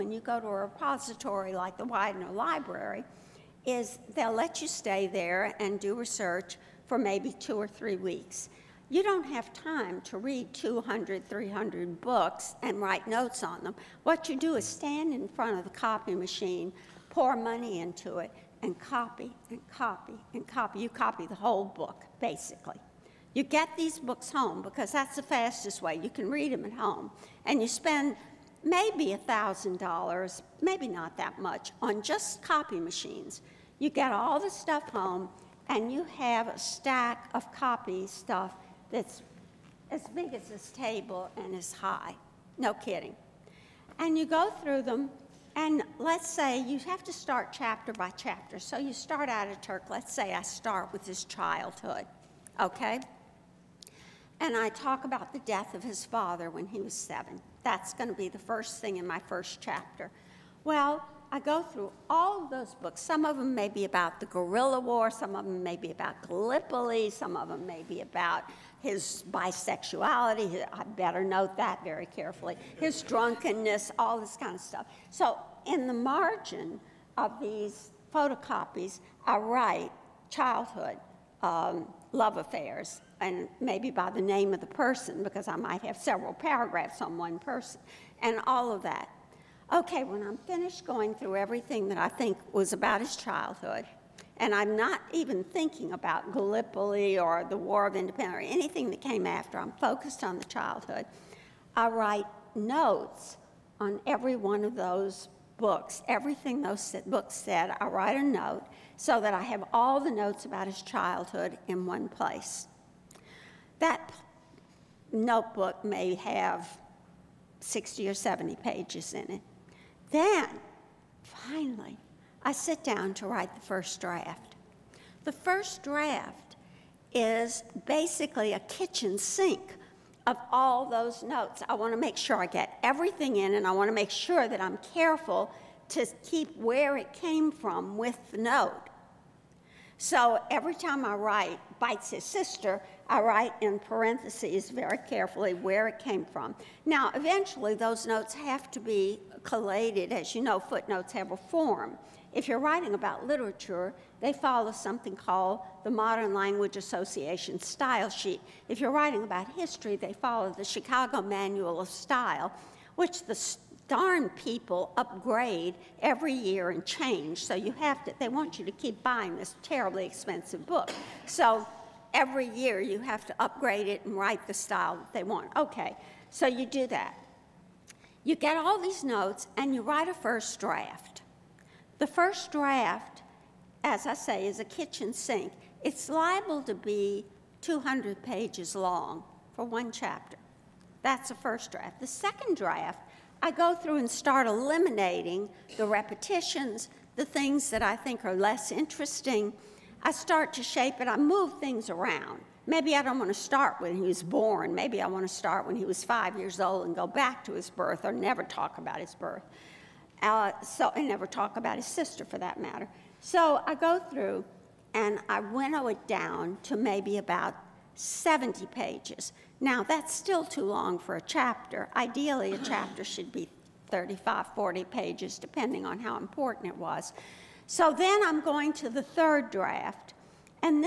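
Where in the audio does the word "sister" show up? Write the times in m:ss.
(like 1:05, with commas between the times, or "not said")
2:22, 3:31.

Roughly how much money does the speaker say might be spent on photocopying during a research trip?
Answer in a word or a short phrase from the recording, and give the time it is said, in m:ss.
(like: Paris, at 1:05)
$1,000, at 0:29.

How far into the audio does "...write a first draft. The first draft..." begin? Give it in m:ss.
2:59.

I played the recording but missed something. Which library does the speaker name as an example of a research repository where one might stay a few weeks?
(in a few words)
Widener Library.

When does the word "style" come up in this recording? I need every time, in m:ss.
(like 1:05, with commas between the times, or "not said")
2:37, 2:41, 2:54.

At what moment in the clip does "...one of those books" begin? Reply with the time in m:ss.
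1:44.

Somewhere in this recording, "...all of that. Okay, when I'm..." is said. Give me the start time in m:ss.
1:28.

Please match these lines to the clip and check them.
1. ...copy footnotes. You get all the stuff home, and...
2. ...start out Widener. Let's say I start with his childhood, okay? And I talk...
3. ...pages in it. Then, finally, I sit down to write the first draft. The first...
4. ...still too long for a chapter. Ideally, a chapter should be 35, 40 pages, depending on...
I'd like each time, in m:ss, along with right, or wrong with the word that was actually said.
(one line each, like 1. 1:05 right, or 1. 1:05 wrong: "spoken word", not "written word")
1. 0:32 wrong: "machines", not "footnotes"
2. 0:48 wrong: "Ataturk", not "Widener"
3. 1:58 right
4. 3:40 right.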